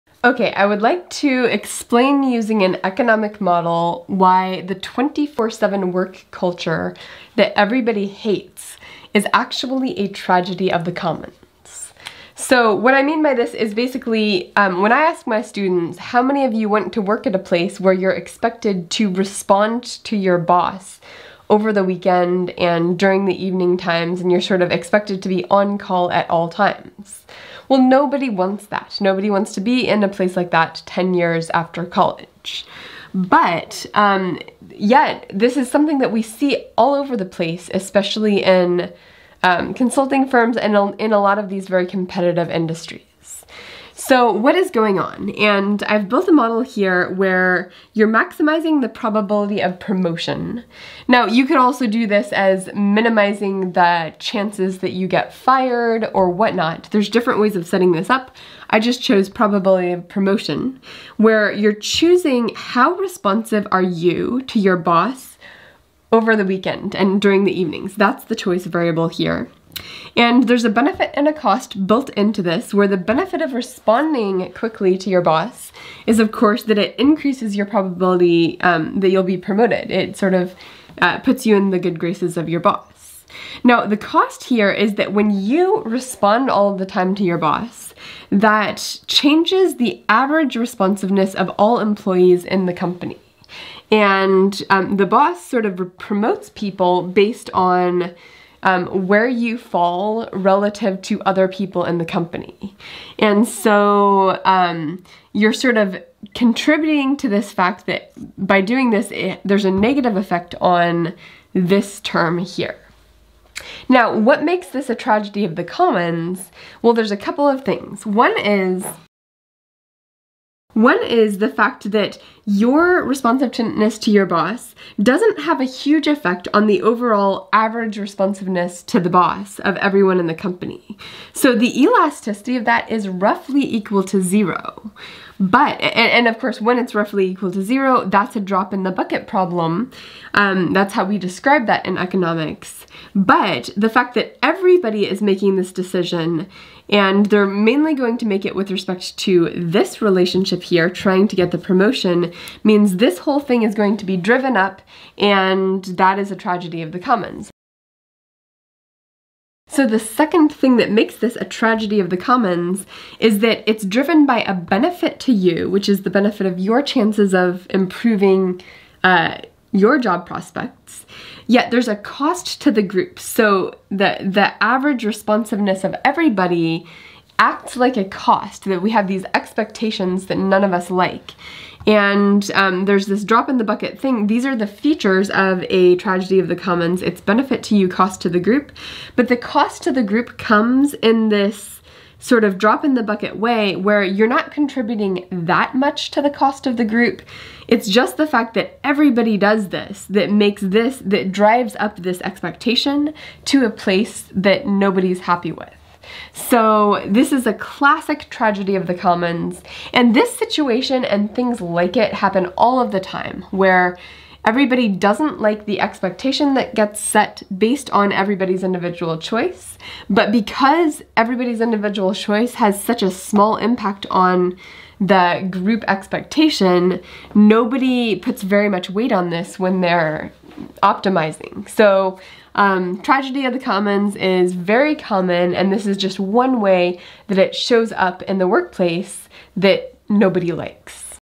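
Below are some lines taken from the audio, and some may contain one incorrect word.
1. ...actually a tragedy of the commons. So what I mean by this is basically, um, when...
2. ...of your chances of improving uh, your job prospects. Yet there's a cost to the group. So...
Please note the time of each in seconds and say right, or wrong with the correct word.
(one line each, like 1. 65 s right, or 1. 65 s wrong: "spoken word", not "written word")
1. 9 s right
2. 166 s right.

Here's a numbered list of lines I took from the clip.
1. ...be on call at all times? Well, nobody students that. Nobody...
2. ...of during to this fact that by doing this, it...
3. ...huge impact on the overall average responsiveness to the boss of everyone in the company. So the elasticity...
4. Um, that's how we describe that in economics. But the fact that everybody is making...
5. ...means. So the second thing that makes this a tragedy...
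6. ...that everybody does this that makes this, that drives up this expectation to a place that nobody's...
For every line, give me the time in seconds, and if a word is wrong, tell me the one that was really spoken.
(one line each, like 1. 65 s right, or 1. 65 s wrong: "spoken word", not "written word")
1. 25 s wrong: "wants", not "students"
2. 105 s wrong: "contributing", not "during"
3. 125 s wrong: "effect", not "impact"
4. 140 s right
5. 156 s wrong: "commons", not "means"
6. 198 s right.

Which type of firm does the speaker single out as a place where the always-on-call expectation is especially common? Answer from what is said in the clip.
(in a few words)
consulting firms.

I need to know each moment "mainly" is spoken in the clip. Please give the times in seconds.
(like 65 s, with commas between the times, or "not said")
147 s.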